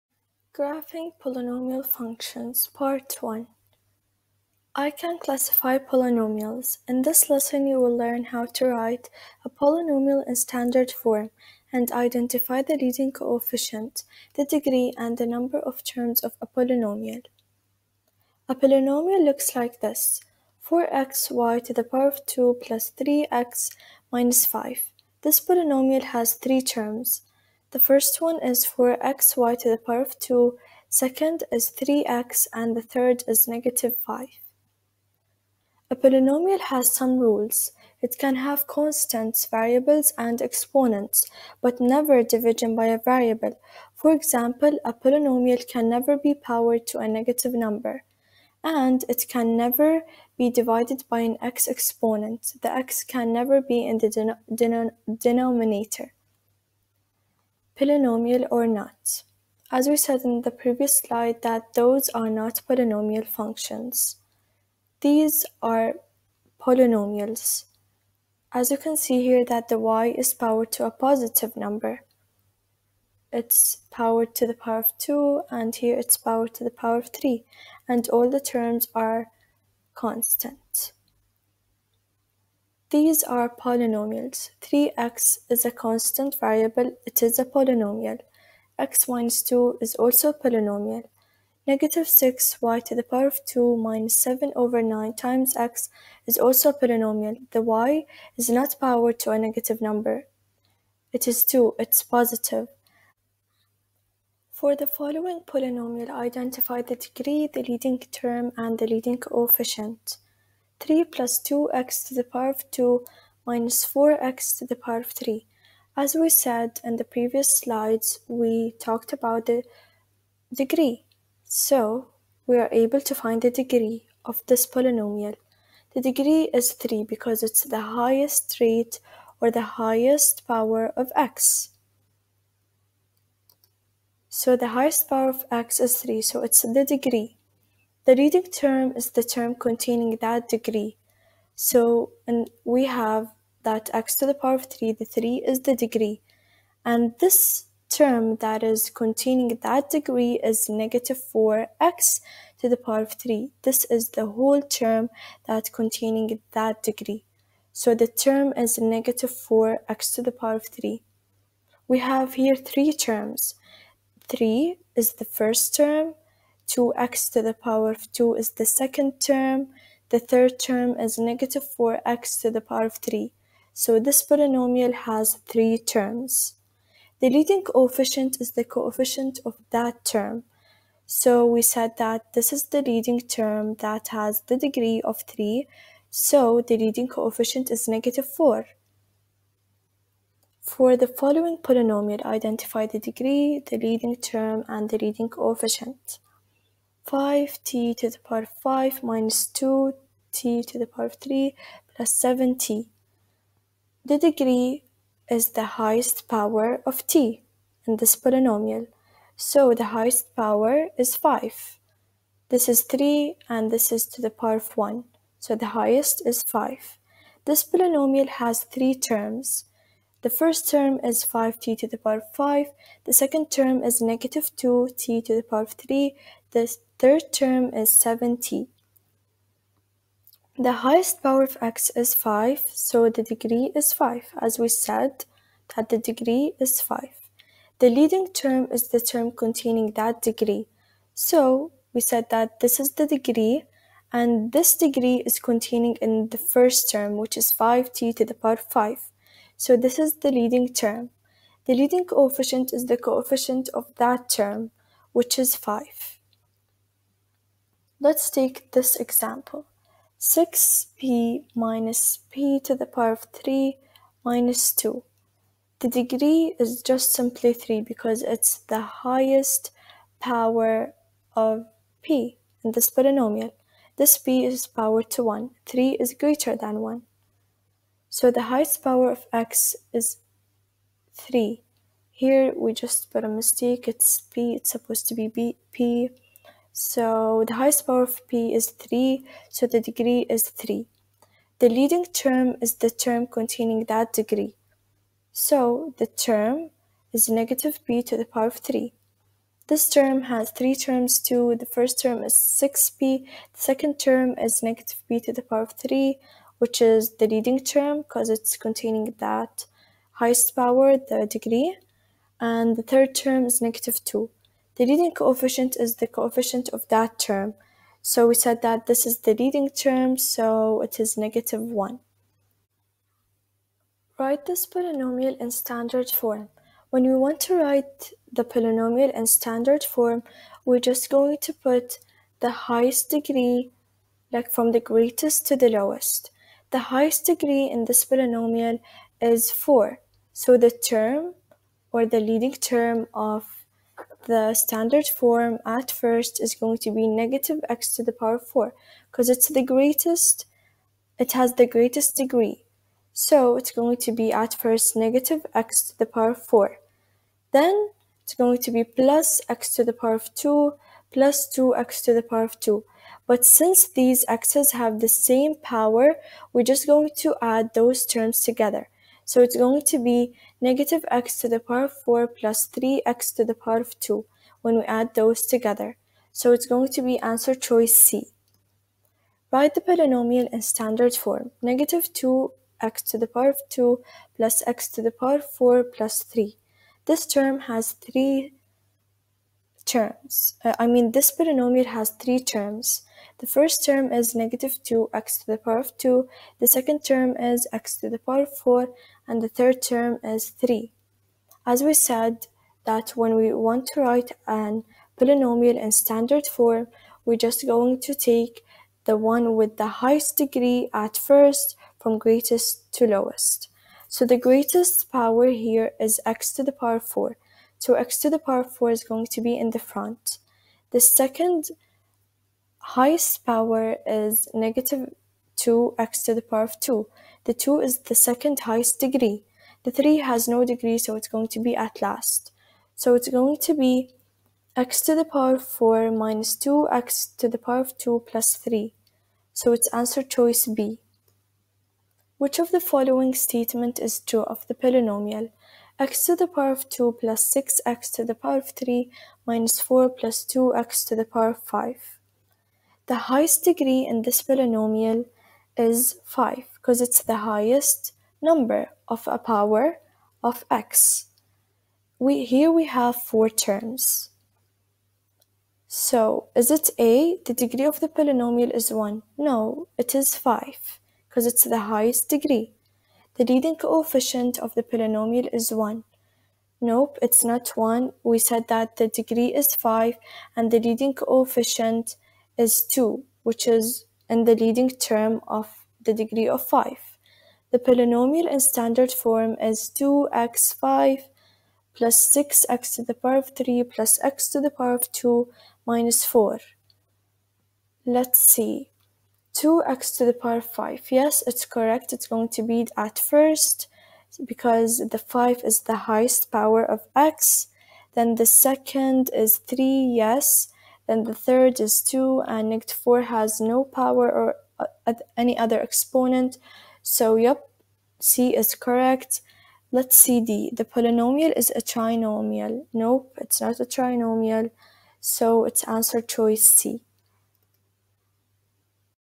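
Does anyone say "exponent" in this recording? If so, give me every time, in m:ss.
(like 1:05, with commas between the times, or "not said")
0:40, 0:51, 8:35.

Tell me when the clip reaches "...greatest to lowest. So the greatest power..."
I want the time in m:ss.
6:52.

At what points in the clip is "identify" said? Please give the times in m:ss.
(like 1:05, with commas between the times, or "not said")
0:11, 1:46, 3:12.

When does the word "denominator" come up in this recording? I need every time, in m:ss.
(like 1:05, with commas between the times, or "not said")
0:55.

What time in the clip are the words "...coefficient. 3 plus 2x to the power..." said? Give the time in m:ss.
1:49.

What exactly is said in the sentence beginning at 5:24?
Write this polynomial in standard form.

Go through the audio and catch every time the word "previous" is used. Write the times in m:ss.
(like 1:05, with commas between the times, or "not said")
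1:00, 1:57.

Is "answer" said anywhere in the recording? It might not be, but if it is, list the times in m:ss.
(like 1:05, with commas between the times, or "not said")
6:17, 7:19, 8:45.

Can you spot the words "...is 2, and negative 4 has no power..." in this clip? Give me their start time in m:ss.
8:31.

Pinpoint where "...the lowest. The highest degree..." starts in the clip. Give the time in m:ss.
5:35.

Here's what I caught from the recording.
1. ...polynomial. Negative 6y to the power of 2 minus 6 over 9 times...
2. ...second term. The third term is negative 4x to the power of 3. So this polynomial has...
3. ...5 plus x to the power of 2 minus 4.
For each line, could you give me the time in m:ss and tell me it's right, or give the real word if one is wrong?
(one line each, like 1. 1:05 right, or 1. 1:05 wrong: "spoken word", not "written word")
1. 1:30 wrong: "7", not "6"
2. 2:48 right
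3. 8:13 wrong: "3", not "5".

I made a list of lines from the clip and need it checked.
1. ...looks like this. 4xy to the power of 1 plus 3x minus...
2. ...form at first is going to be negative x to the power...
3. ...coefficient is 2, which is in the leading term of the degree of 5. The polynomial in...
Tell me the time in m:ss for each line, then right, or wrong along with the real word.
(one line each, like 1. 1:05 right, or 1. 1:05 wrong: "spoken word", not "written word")
1. 0:19 wrong: "2", not "1"
2. 5:45 right
3. 8:01 right.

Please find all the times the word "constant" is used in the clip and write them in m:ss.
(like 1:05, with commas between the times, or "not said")
0:38, 1:19, 1:25.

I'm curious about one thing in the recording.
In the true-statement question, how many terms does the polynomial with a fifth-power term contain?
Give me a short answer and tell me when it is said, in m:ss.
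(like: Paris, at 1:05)
4, at 7:43.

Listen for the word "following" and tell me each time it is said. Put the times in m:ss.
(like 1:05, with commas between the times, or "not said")
1:44, 3:11, 7:22.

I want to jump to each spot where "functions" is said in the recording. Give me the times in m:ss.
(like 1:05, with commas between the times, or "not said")
0:01, 1:03.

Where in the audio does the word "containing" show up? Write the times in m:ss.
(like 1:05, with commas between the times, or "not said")
2:19, 2:28, 2:35, 3:59, 4:05, 4:53, 5:08.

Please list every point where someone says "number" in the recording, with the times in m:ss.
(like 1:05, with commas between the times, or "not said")
0:15, 0:47, 1:11, 1:39, 7:38.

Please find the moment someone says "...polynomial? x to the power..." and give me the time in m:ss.
7:24.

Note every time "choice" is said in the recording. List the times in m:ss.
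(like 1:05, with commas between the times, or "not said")
6:17, 7:20, 8:46.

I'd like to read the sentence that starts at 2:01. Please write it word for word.
So we are able to find the degree of this polynomial.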